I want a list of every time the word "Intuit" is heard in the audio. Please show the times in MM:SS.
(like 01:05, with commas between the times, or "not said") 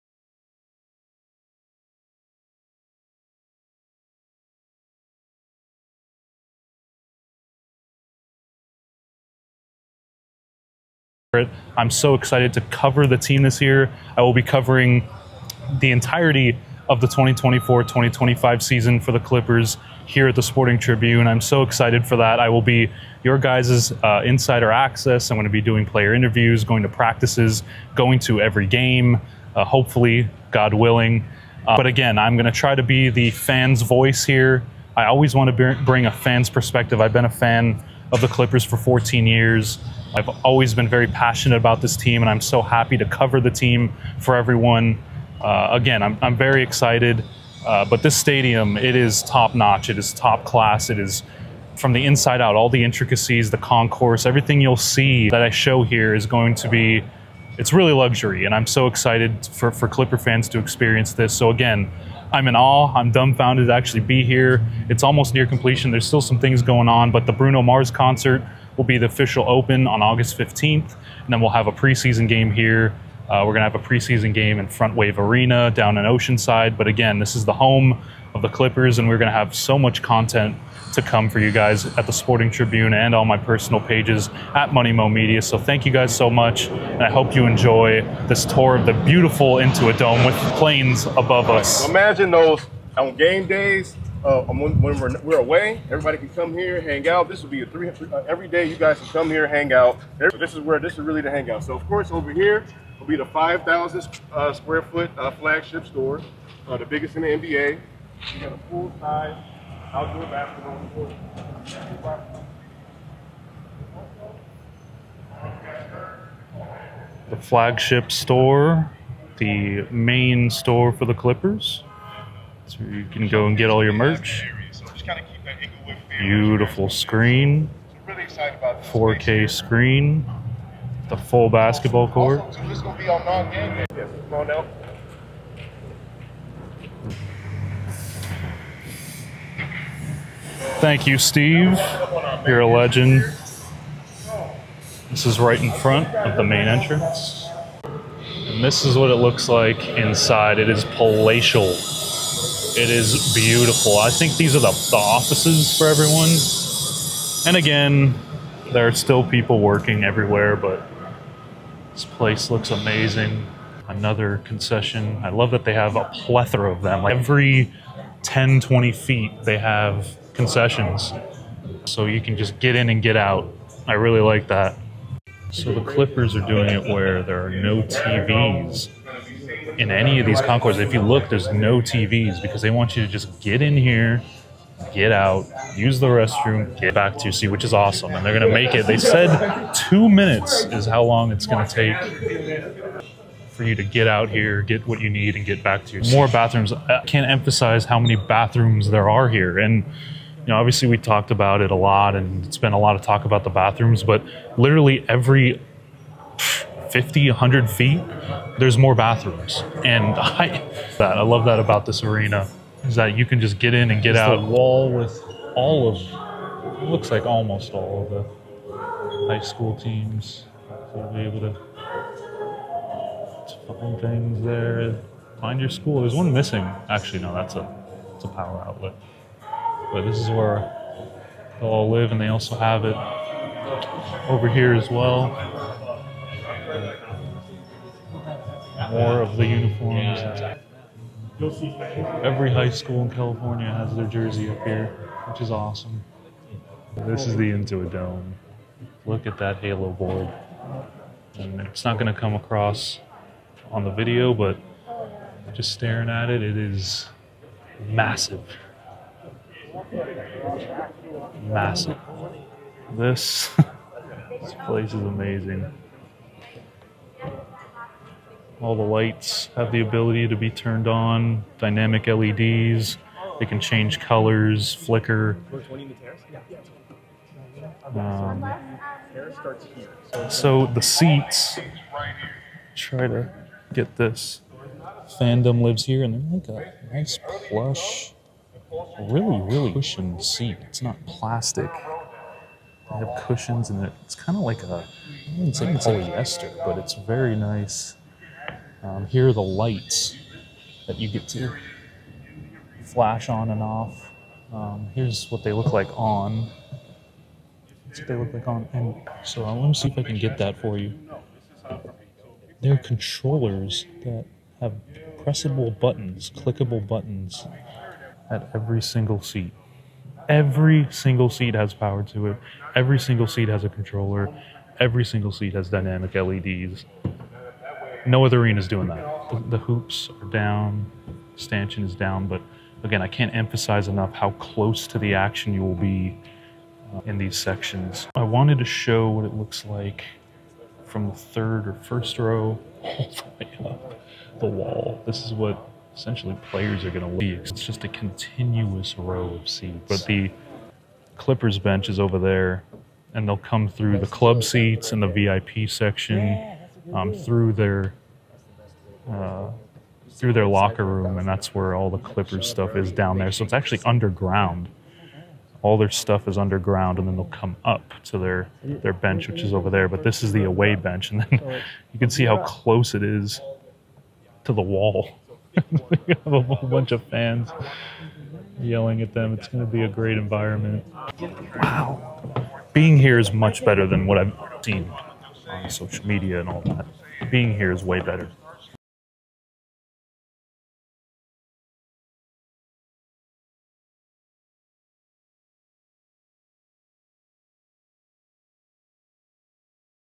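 01:29, 04:07.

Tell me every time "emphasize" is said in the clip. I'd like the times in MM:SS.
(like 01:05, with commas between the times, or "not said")
03:17, 05:33.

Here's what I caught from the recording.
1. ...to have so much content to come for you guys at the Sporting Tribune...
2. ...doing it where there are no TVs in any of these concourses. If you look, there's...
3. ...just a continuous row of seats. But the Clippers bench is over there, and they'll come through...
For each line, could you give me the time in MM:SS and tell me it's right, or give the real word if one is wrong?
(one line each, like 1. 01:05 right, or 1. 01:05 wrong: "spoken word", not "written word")
1. 01:19 right
2. 02:56 right
3. 05:47 right.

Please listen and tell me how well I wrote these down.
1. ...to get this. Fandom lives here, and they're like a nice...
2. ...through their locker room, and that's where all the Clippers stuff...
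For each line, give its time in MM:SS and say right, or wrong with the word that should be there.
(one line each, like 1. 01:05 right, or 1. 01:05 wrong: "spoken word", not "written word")
1. 04:43 right
2. 06:00 right.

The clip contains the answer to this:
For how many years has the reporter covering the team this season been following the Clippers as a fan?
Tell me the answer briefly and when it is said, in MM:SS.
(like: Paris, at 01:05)
14 years, at 00:38.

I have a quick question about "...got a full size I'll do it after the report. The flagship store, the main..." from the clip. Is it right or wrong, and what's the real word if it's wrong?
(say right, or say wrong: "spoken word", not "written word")
right.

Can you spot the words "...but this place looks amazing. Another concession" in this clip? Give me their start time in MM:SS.
02:40.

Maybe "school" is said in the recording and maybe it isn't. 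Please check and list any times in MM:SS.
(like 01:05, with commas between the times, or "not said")
03:39, 03:45, 04:02.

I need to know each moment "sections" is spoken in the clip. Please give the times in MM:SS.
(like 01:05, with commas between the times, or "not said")
05:37, 05:55.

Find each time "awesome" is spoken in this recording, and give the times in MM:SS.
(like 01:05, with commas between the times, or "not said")
03:07, 04:05.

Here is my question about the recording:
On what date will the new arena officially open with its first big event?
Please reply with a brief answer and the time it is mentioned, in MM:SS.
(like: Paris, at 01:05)
August 15th, at 01:10.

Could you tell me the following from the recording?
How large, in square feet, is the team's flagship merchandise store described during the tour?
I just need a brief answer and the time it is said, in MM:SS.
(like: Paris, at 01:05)
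5,000, at 01:43.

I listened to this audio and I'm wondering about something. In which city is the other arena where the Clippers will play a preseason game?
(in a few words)
Oceanside.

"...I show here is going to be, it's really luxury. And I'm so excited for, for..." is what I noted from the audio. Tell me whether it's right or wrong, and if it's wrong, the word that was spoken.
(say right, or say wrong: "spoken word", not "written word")
right.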